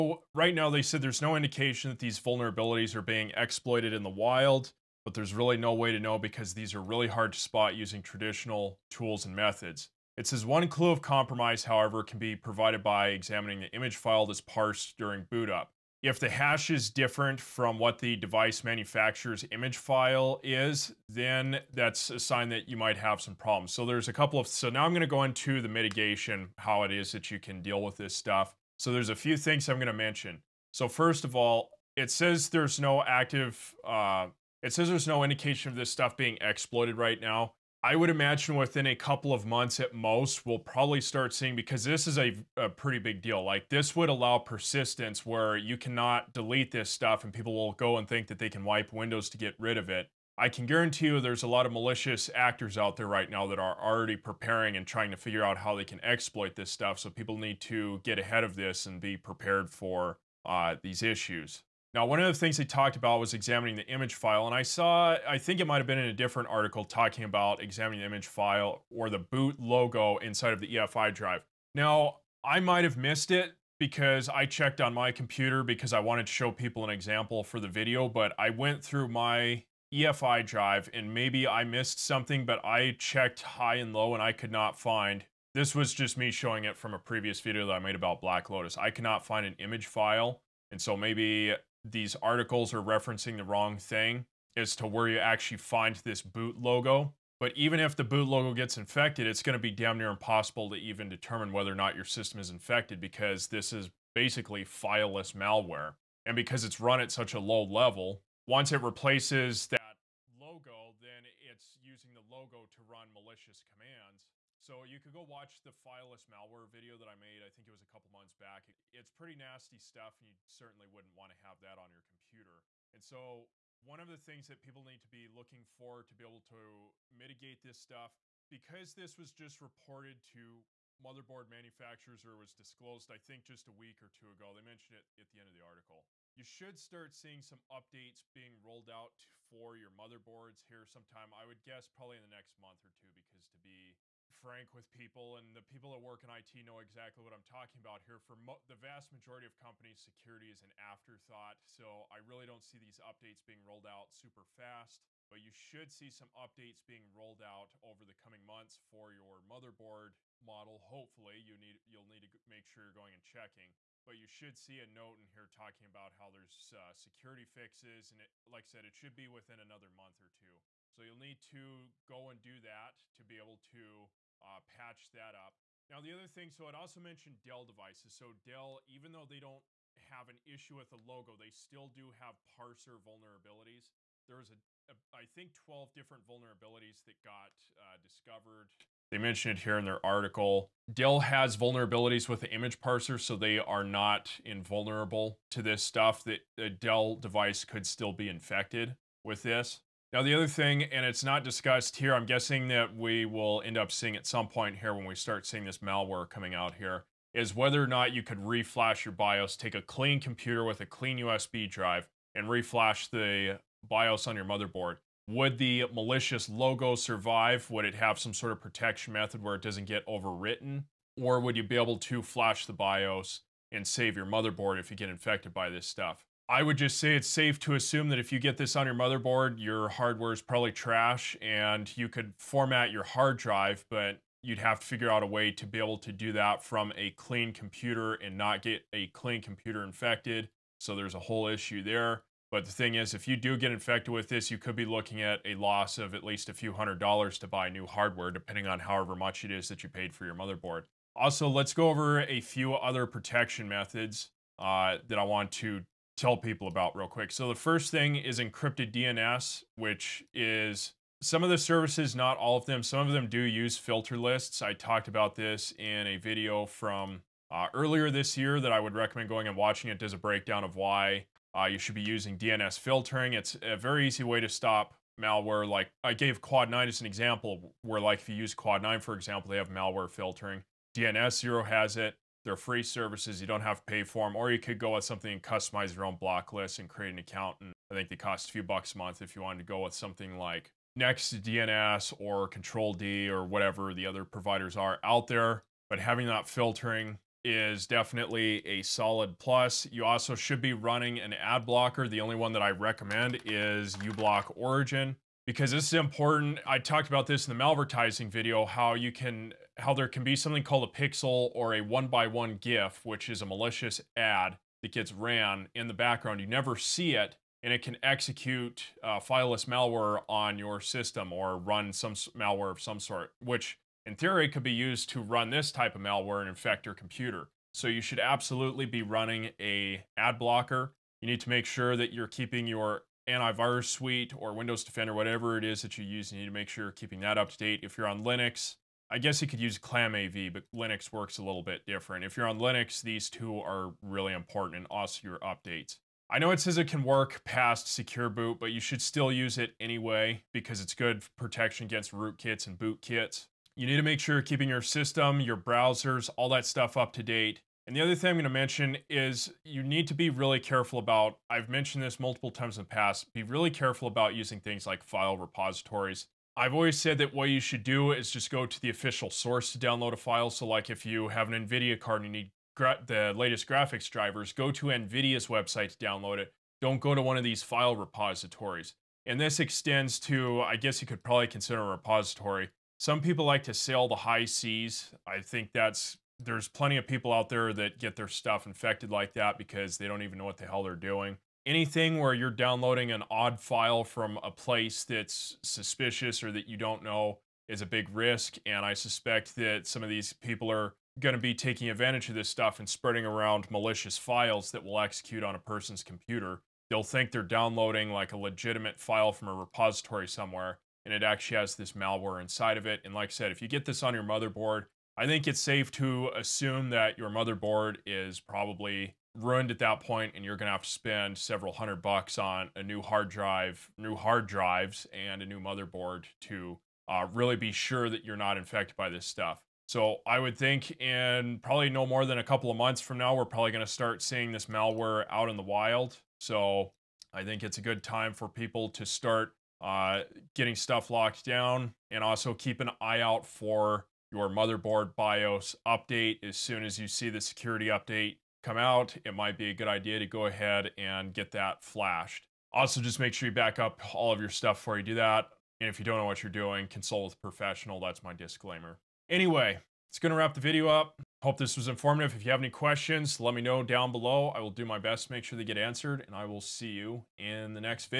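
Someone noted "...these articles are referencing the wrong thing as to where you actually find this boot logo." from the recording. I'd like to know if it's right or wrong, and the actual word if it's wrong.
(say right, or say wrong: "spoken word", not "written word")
right.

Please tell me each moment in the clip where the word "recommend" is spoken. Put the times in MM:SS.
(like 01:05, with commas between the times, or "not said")
04:28, 05:02.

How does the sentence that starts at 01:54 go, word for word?
So you could go watch the fileless malware video that I made.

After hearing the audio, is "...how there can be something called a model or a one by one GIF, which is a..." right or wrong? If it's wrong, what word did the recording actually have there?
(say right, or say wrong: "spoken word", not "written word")
wrong: "pixel", not "model".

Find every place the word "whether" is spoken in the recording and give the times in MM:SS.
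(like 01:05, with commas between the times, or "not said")
01:41, 03:27.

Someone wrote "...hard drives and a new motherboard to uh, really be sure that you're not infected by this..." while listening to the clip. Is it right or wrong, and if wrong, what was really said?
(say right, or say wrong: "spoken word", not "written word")
right.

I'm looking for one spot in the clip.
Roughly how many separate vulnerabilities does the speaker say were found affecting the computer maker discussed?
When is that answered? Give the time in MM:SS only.
03:05.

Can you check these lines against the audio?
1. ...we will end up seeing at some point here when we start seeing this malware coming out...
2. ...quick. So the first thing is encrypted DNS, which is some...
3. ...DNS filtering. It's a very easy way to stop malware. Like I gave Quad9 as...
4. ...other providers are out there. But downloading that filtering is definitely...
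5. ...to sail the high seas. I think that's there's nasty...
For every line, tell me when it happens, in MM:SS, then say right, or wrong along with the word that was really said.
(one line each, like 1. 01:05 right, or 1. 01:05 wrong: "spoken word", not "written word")
1. 03:22 right
2. 04:17 right
3. 04:32 right
4. 04:54 wrong: "having", not "downloading"
5. 06:23 wrong: "plenty", not "nasty".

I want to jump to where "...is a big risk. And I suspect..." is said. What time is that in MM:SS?
06:37.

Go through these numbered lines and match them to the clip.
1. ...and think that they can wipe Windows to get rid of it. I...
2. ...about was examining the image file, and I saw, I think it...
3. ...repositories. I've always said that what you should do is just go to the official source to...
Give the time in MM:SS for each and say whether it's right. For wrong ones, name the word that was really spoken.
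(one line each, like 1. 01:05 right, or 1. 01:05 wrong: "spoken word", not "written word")
1. 00:47 right
2. 01:02 right
3. 06:05 right.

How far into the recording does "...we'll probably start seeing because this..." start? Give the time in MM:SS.
00:40.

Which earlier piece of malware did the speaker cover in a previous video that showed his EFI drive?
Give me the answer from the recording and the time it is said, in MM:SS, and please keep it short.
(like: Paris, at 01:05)
Black Lotus, at 01:28.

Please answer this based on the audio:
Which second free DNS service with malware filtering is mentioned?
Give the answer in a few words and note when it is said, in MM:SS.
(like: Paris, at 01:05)
DNS Zero, at 04:40.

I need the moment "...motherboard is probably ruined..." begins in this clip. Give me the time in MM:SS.
06:57.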